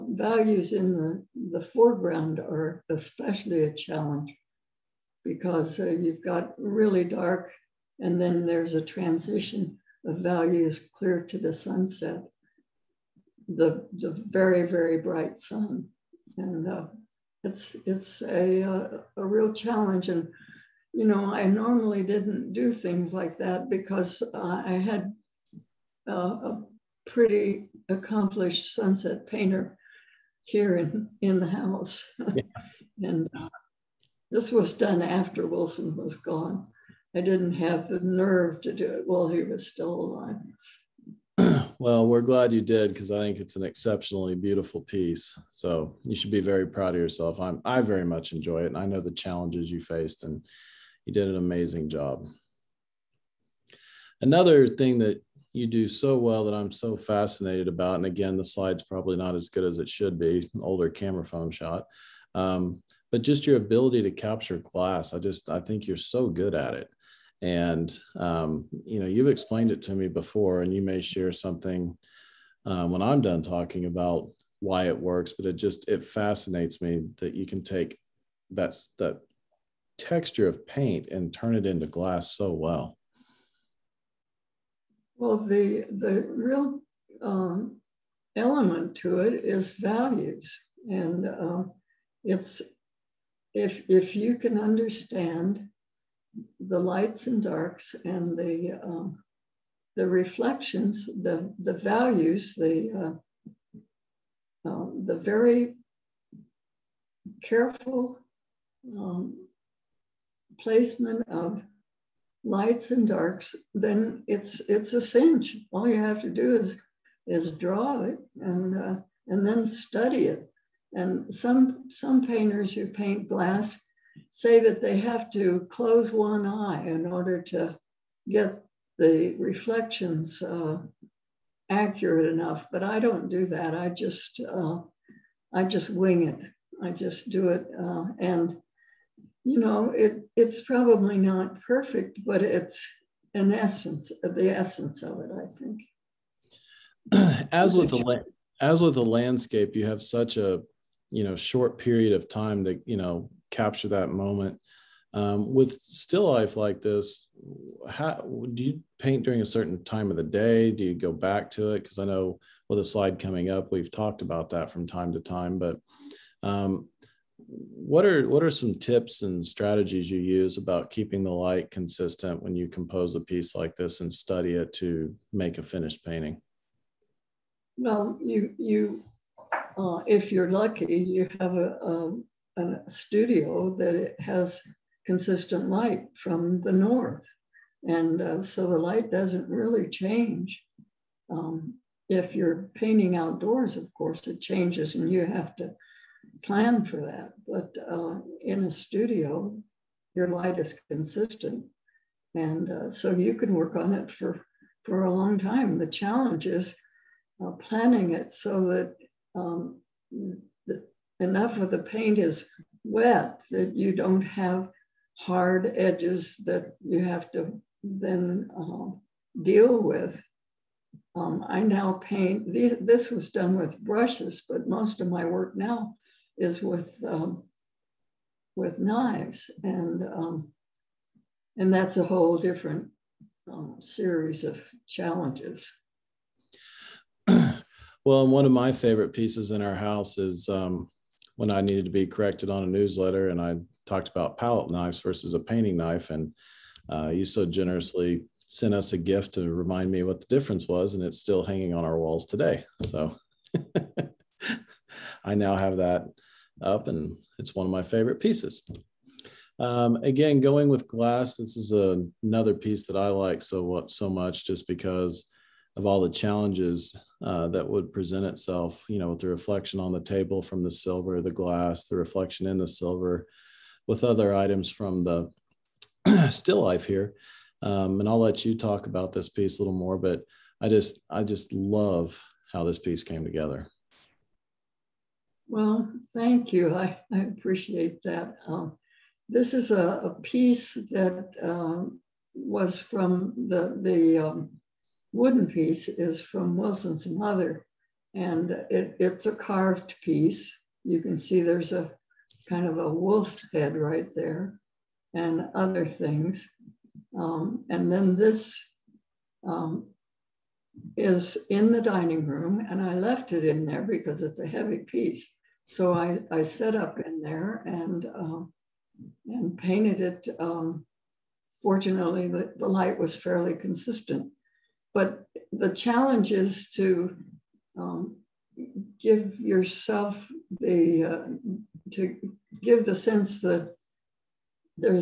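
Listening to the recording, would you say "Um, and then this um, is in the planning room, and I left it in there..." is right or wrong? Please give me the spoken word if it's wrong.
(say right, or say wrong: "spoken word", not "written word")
wrong: "dining", not "planning".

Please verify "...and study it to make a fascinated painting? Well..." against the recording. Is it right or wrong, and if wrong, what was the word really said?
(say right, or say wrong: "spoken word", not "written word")
wrong: "finished", not "fascinated".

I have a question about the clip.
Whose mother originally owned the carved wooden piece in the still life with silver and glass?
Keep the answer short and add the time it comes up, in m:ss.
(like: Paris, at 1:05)
Wilson's mother, at 4:56.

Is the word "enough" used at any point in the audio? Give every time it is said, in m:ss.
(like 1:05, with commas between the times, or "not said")
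2:12, 3:31.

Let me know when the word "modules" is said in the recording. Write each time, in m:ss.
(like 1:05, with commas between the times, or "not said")
not said.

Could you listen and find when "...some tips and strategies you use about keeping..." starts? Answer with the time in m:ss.
2:48.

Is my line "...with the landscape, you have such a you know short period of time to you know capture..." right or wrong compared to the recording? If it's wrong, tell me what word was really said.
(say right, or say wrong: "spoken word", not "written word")
right.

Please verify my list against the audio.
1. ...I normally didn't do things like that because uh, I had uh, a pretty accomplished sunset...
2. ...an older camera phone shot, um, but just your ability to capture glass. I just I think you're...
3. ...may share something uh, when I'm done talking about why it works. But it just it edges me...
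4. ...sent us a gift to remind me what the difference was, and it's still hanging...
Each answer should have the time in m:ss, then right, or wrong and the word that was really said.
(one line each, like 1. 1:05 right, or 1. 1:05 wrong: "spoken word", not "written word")
1. 0:21 right
2. 1:00 right
3. 1:10 wrong: "fascinates", not "edges"
4. 4:08 right.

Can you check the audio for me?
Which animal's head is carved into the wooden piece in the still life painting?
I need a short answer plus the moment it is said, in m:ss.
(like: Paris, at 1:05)
A wolf, at 5:02.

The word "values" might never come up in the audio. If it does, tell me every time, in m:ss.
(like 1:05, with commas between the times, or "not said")
0:00, 0:10, 1:29, 1:41.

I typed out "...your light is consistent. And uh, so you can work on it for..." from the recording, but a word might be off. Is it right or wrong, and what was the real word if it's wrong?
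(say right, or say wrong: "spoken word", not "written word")
right.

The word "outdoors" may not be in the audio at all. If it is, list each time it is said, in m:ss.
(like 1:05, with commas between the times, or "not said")
3:13.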